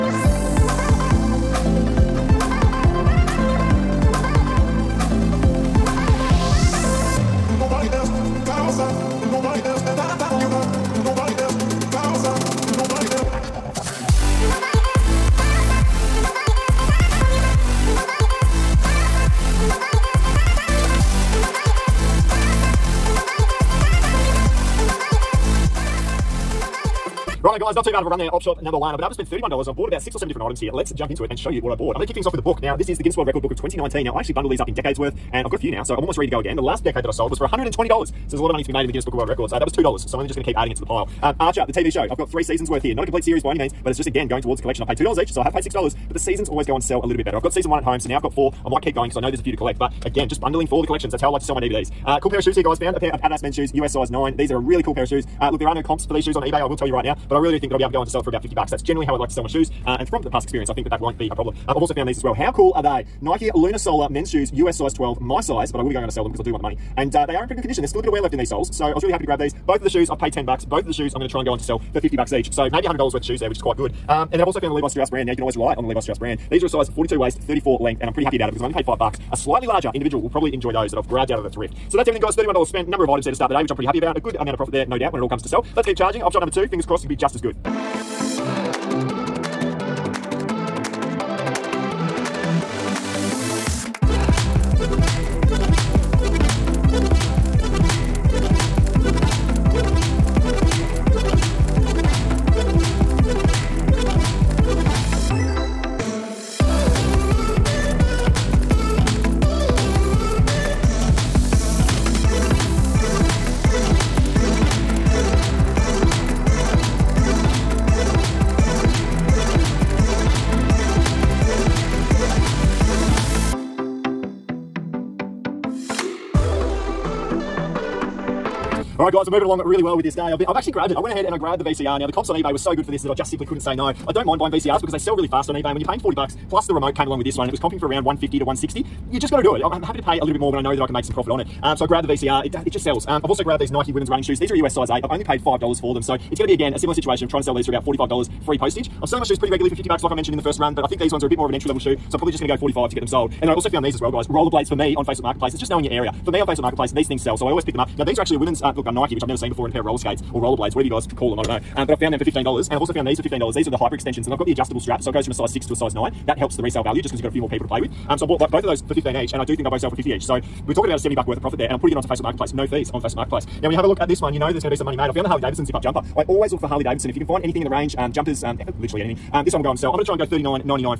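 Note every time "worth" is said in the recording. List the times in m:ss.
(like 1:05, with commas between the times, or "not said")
0:34, 0:42, 1:13, 2:51.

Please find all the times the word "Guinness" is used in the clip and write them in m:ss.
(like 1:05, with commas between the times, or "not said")
0:33, 0:38.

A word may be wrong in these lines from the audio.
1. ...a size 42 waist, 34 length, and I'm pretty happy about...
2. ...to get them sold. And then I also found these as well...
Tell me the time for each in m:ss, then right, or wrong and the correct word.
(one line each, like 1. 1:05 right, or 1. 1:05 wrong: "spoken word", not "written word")
1. 1:16 right
2. 2:32 right.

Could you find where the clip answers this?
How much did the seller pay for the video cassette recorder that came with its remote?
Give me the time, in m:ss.
2:15.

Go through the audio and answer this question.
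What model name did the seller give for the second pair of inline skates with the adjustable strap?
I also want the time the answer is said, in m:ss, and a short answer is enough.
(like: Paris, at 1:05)
hyper extensions, at 2:43.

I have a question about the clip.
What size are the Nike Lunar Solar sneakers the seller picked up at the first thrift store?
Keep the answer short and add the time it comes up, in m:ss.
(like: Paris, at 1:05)
US size 12, at 1:04.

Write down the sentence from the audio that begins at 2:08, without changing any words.
All right, guys, we're moving along really well with this day.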